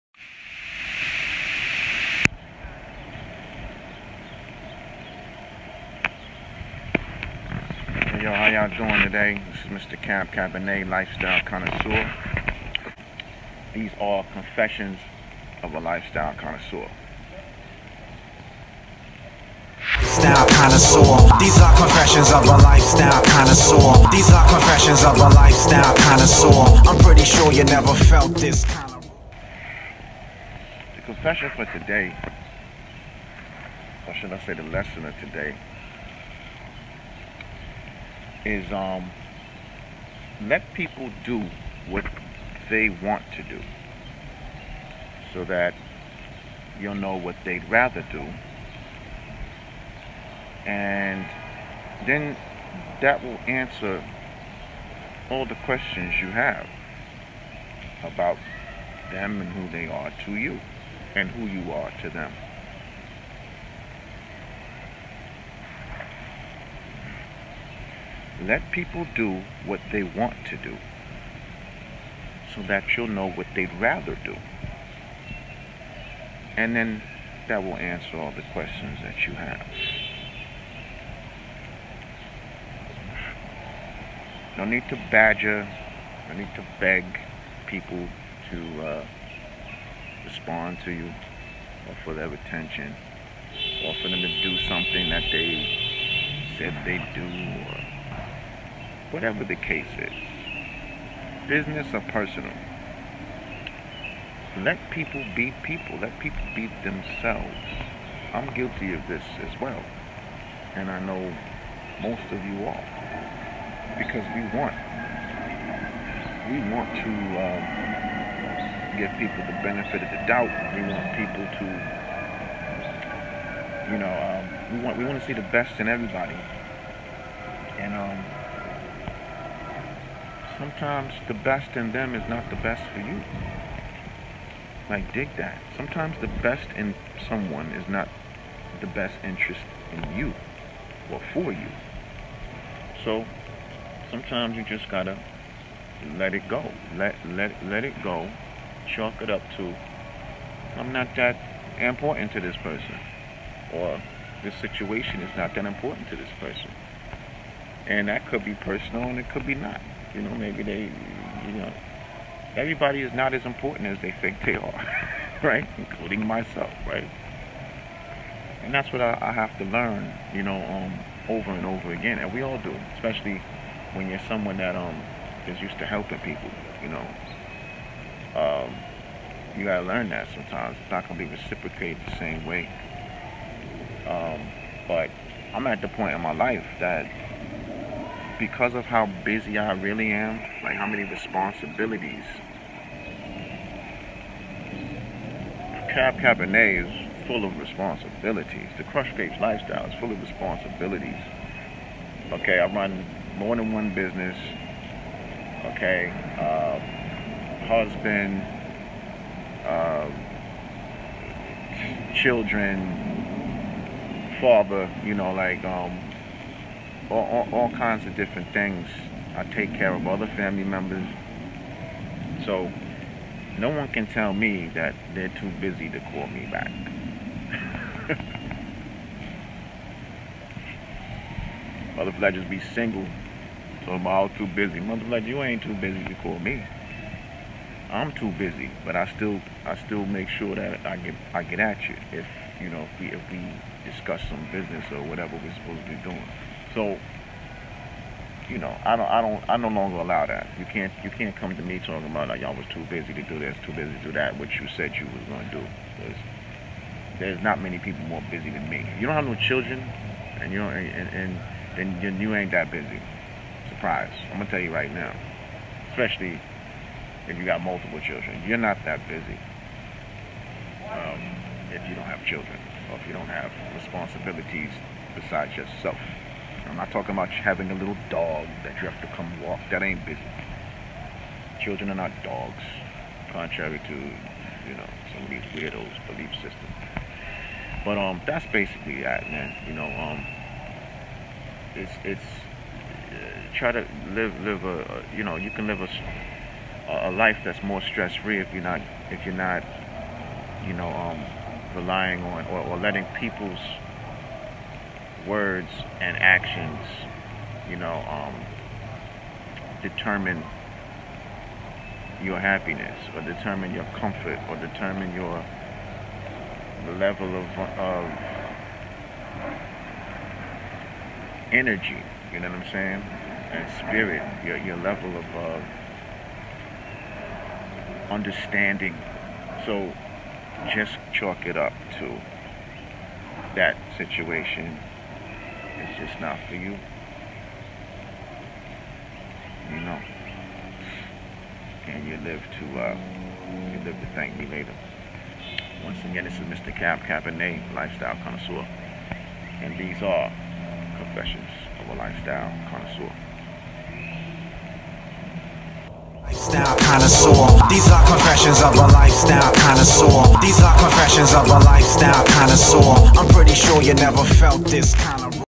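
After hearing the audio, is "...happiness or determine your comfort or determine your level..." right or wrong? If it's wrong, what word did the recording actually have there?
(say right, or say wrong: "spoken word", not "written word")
right.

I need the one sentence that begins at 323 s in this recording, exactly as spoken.
And spirit, your, your level of uh, understanding.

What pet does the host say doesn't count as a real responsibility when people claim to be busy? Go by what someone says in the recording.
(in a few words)
a little dog.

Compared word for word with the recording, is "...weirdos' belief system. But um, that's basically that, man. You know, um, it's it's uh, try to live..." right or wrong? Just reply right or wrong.
right.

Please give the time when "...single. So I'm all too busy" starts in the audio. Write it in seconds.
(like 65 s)
232 s.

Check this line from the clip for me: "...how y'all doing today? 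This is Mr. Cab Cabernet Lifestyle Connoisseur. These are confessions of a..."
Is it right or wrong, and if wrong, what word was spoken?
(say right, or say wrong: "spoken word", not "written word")
right.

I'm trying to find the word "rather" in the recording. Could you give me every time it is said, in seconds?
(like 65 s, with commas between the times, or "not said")
47 s, 73 s.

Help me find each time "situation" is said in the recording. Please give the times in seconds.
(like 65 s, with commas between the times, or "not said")
154 s, 333 s.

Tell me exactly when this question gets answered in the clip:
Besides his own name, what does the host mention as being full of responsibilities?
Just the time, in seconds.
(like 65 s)
198 s.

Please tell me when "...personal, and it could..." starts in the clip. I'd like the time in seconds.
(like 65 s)
158 s.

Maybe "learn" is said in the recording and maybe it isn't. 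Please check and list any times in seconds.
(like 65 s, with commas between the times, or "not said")
169 s, 179 s.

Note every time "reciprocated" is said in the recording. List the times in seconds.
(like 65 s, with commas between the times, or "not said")
181 s.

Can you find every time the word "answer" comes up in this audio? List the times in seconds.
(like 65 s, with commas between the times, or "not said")
53 s, 77 s.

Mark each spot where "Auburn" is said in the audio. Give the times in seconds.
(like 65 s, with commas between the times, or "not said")
not said.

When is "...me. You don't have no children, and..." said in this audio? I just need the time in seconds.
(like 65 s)
258 s.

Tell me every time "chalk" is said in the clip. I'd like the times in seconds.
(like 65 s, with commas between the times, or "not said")
148 s, 331 s.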